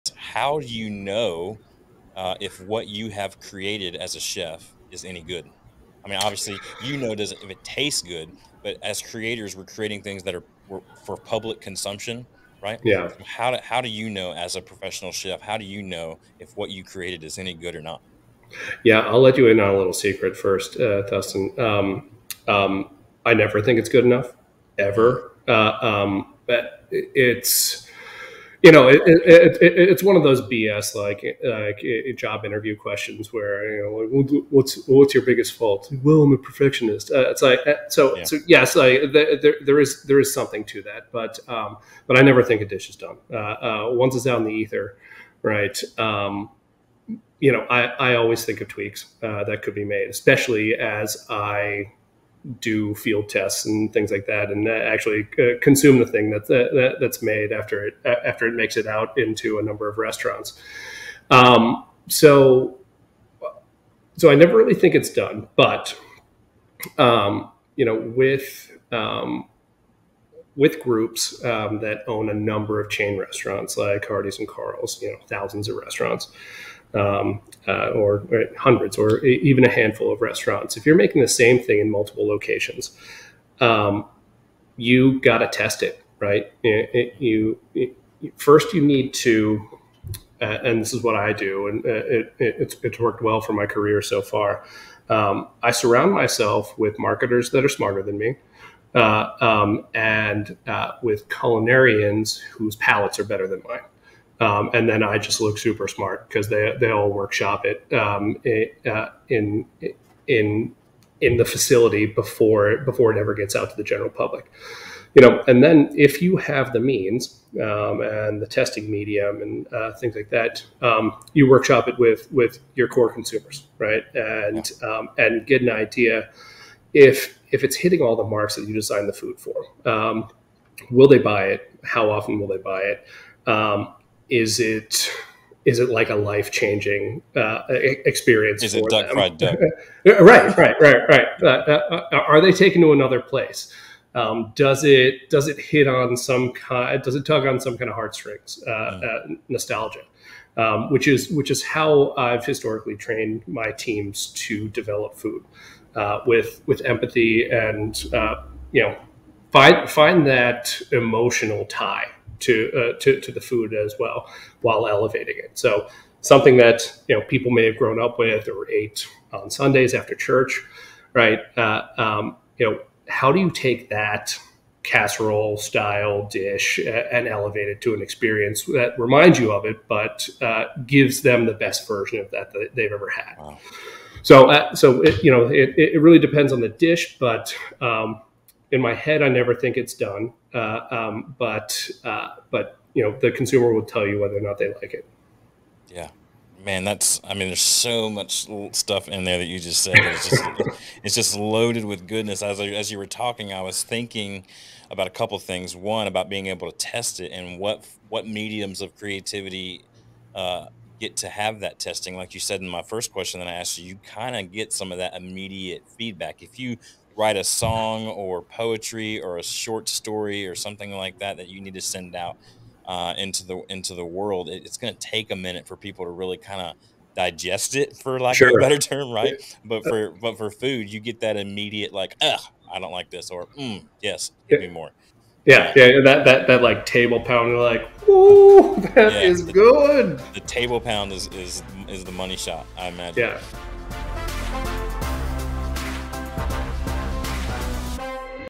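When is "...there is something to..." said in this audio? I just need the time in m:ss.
0:40.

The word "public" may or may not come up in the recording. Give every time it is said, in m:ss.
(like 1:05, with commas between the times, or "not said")
0:11, 1:54.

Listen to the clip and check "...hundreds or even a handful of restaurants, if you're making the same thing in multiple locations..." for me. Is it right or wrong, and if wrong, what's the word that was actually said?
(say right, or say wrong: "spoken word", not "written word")
right.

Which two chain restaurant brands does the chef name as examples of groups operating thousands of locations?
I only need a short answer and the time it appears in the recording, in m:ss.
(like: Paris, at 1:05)
Hardee's and Carl's, at 1:14.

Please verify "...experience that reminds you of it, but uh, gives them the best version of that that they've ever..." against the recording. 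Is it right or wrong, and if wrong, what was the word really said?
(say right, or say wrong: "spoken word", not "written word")
right.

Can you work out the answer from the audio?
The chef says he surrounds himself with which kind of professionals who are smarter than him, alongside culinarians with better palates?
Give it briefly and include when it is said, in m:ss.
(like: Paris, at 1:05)
Marketers, at 1:36.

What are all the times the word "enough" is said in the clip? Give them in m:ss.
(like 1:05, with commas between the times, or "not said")
0:24.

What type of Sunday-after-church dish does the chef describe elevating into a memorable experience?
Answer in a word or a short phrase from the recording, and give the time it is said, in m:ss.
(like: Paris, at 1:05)
Casserole, at 2:54.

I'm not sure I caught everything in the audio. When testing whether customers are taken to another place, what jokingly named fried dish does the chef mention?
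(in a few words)
Fried duck.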